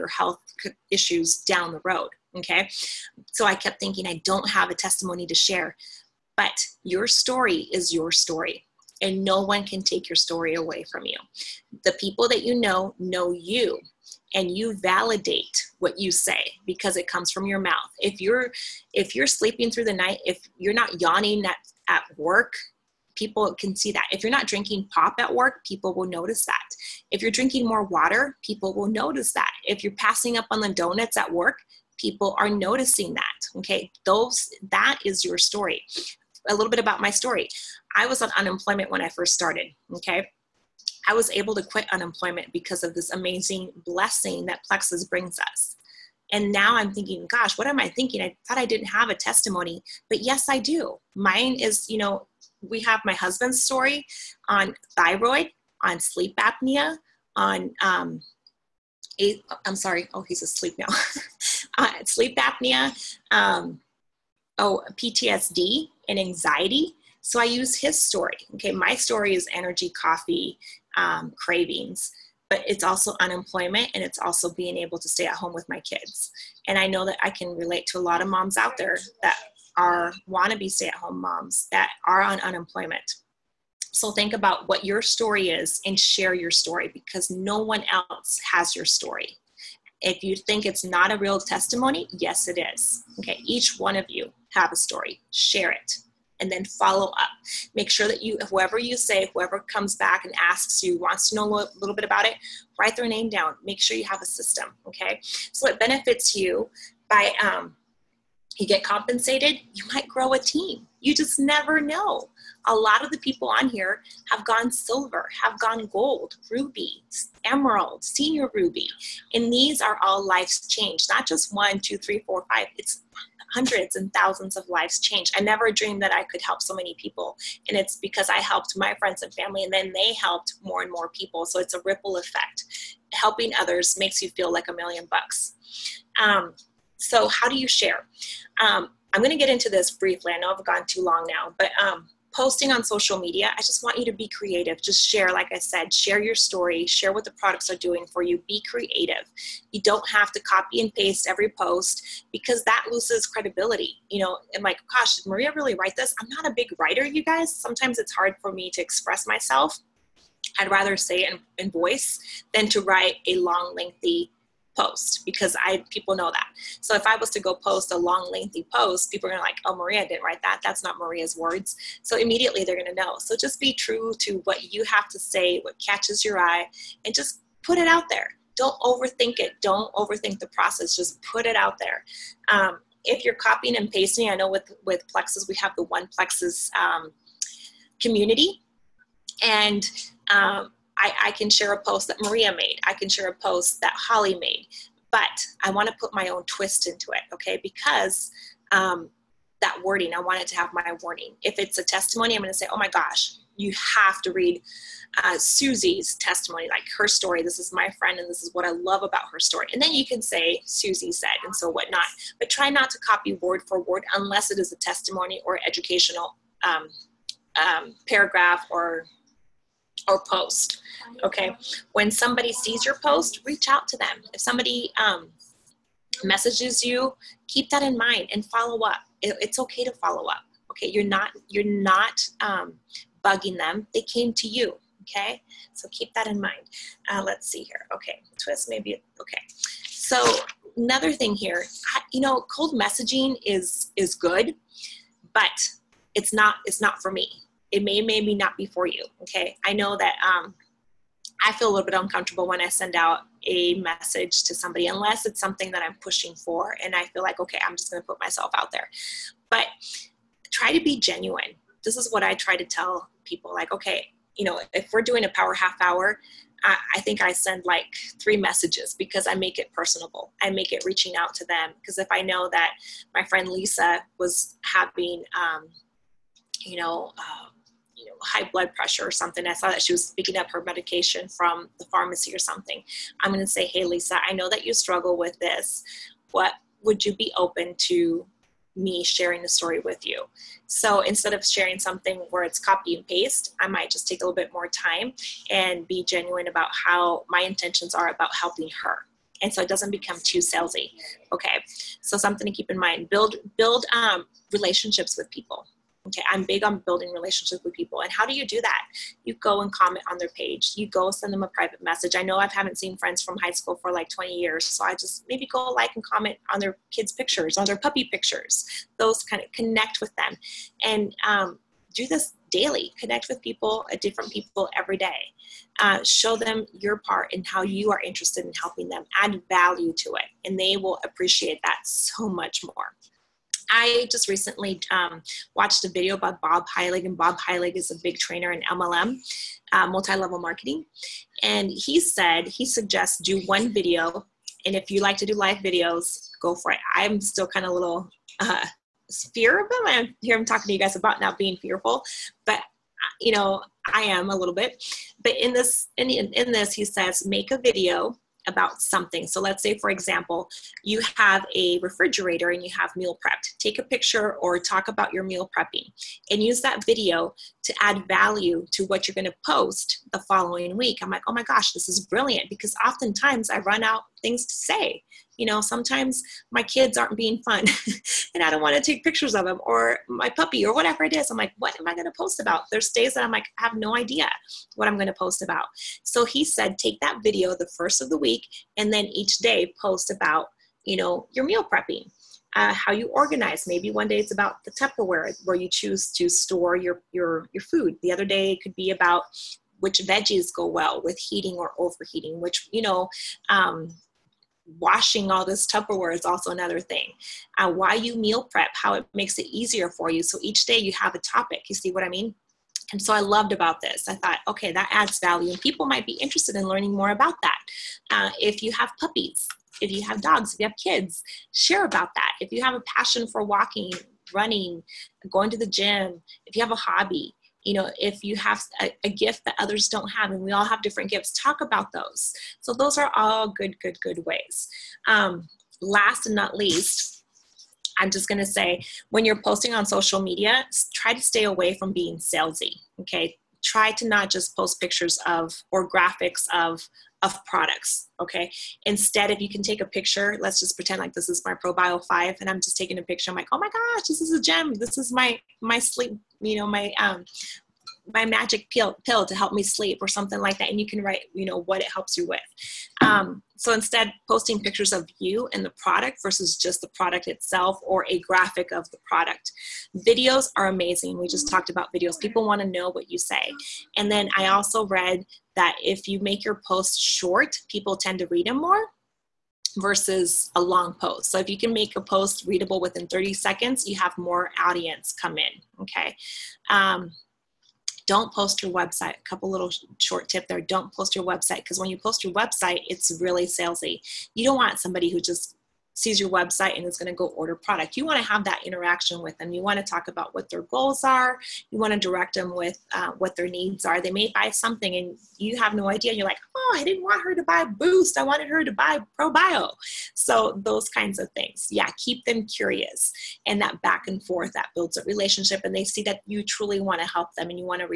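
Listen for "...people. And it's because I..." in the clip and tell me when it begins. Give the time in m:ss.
2:06.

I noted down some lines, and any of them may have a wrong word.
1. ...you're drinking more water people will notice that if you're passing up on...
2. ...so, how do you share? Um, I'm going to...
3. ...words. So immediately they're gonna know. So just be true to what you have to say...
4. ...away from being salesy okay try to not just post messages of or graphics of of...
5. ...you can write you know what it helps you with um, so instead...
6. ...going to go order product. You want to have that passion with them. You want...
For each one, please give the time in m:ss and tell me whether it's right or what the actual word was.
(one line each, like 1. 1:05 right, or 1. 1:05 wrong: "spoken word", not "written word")
1. 0:27 right
2. 2:16 right
3. 2:51 right
4. 7:21 wrong: "pictures", not "messages"
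5. 7:40 right
6. 8:16 wrong: "interaction", not "passion".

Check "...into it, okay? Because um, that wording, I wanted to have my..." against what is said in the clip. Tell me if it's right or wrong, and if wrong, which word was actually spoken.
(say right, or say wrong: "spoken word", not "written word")
right.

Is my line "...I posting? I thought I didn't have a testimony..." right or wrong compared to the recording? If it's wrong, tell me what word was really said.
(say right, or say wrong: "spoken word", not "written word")
wrong: "thinking", not "posting".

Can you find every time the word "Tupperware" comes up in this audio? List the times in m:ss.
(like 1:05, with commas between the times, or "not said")
6:34, 6:45.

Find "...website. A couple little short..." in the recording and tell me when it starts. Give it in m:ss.
8:08.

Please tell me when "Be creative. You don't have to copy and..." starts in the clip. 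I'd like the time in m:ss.
2:28.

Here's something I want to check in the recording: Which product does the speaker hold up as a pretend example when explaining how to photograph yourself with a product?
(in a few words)
ProBio 5.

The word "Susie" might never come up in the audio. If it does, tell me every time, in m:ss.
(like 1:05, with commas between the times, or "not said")
3:25, 3:30.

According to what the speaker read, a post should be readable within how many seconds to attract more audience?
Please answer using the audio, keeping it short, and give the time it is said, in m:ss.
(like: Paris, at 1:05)
30 seconds, at 8:03.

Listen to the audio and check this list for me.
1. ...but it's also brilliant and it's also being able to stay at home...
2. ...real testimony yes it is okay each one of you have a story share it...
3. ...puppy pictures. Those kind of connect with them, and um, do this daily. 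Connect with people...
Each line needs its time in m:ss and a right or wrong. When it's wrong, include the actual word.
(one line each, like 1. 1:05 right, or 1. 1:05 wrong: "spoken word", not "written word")
1. 1:12 wrong: "unemployment", not "brilliant"
2. 1:31 right
3. 5:17 right.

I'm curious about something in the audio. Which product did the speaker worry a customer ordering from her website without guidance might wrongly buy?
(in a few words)
Boost.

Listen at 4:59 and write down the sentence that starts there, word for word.
And so it doesn't become too salesy.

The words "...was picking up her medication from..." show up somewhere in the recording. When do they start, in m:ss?
4:39.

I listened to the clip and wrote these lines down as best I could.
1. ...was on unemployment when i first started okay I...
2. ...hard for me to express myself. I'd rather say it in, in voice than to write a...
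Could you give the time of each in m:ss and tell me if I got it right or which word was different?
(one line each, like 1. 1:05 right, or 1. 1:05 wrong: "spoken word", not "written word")
1. 0:38 right
2. 2:38 right.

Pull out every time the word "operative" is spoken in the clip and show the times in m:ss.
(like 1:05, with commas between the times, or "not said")
not said.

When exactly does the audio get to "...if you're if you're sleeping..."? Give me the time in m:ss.
0:17.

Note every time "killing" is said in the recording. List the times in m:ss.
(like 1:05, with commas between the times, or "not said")
not said.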